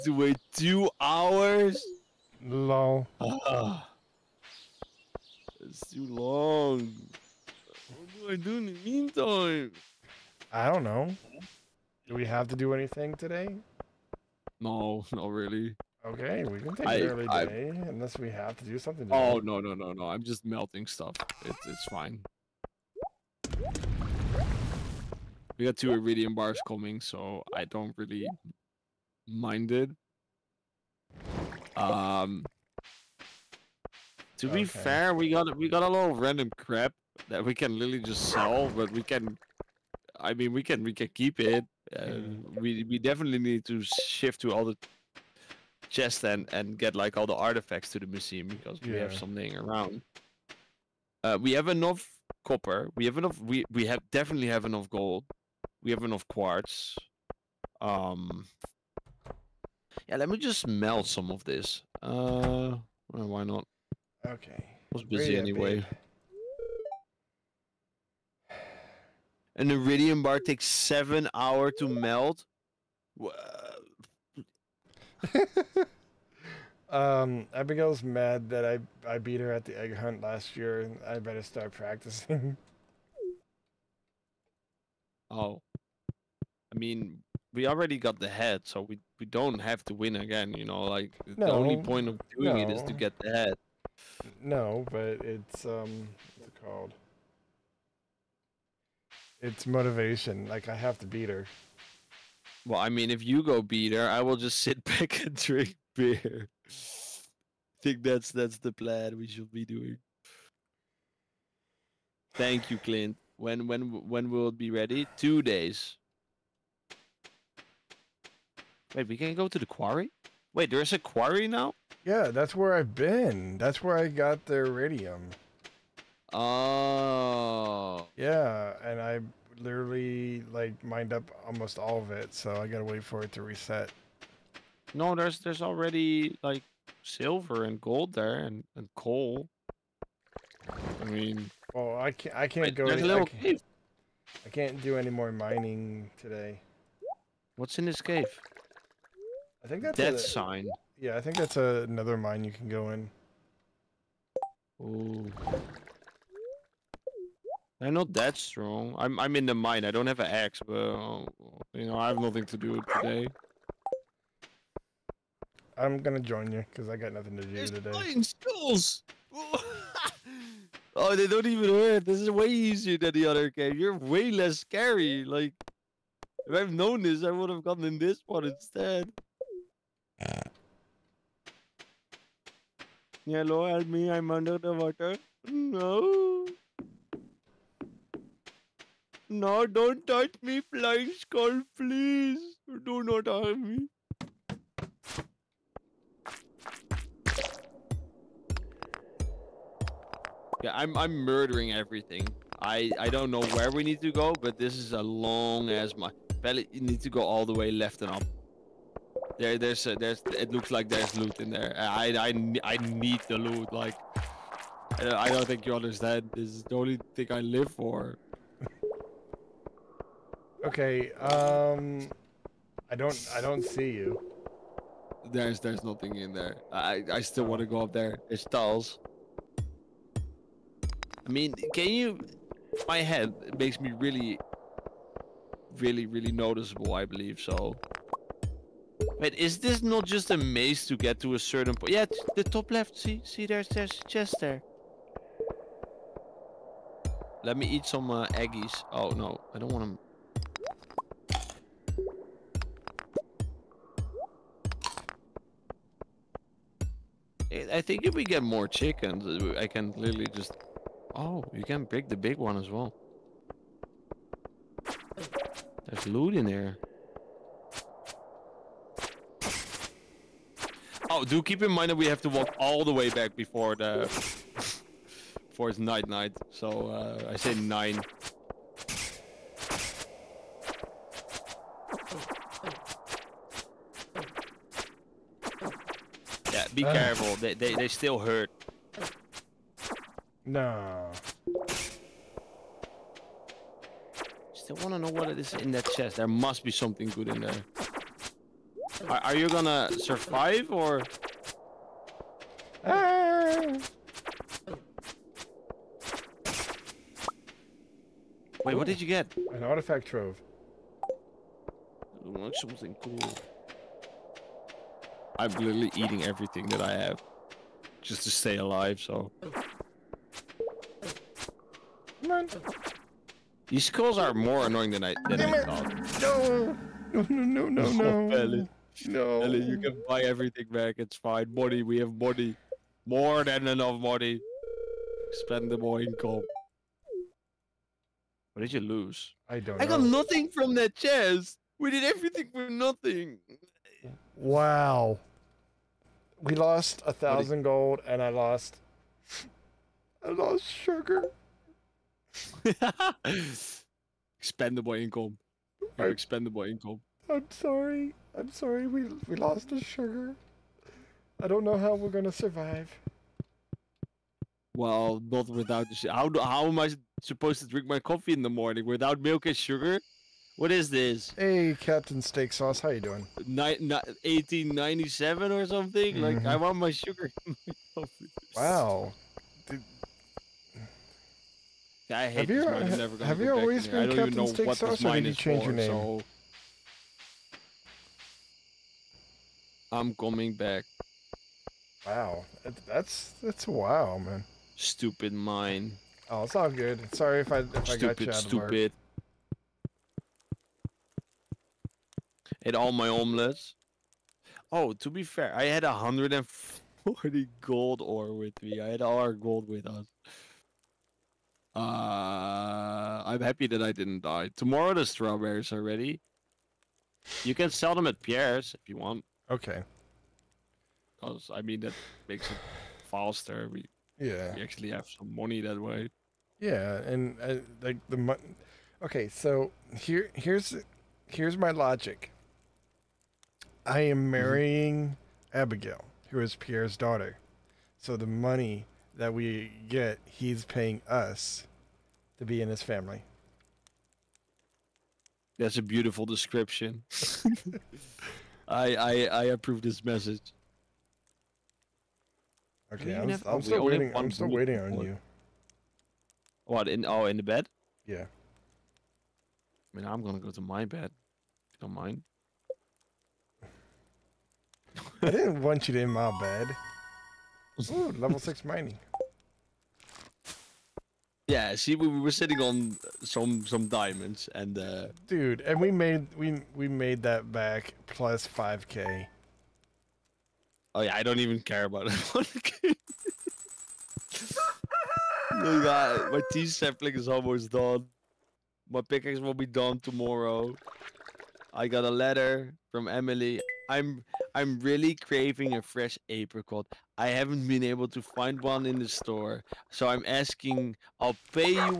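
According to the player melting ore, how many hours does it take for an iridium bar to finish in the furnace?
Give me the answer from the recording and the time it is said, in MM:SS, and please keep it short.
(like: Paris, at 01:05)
7, at 01:10.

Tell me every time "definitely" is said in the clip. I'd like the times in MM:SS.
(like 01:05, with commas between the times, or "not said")
00:42, 00:54.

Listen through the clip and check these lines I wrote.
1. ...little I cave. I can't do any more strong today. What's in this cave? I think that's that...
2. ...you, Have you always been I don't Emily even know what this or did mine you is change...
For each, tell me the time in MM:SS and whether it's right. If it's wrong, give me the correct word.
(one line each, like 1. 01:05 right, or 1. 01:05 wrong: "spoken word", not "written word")
1. 02:23 wrong: "mining", not "strong"
2. 06:22 wrong: "Captain", not "Emily".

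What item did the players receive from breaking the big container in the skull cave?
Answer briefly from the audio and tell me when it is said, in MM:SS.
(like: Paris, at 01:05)
An artifact trove, at 05:09.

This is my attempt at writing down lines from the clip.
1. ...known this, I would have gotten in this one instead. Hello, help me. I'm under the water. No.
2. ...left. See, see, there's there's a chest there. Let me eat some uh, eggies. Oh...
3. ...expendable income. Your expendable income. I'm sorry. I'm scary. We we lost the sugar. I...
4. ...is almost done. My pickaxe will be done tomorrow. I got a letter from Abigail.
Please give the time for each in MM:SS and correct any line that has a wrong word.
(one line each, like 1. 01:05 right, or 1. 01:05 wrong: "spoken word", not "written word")
1. 02:56 right
2. 04:02 right
3. 05:54 wrong: "sorry", not "scary"
4. 08:07 wrong: "Emily", not "Abigail".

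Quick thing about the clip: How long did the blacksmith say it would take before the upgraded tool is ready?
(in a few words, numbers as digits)
Two days.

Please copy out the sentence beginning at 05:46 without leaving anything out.
We lost a thousand gold and I lost I lost sugar.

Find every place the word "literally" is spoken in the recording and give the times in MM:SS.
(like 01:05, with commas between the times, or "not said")
00:37, 02:09, 04:19, 05:15.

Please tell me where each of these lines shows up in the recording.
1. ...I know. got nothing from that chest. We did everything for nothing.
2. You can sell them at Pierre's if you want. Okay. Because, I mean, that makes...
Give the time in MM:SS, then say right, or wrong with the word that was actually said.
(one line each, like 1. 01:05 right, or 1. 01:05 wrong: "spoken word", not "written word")
1. 05:39 right
2. 06:57 right.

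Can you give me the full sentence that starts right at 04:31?
Oh, do keep in mind that we have to walk all the way back before the before it's night night.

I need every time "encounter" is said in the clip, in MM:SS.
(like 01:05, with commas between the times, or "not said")
not said.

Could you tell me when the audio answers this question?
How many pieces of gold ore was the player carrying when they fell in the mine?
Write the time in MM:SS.
06:45.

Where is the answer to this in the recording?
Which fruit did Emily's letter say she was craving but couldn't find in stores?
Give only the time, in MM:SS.
08:16.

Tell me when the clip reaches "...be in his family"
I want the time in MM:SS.
07:22.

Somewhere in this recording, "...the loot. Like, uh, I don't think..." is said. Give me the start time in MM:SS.
03:33.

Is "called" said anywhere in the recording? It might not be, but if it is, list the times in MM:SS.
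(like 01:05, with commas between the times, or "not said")
01:36.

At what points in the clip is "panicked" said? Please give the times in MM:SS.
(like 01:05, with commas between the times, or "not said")
not said.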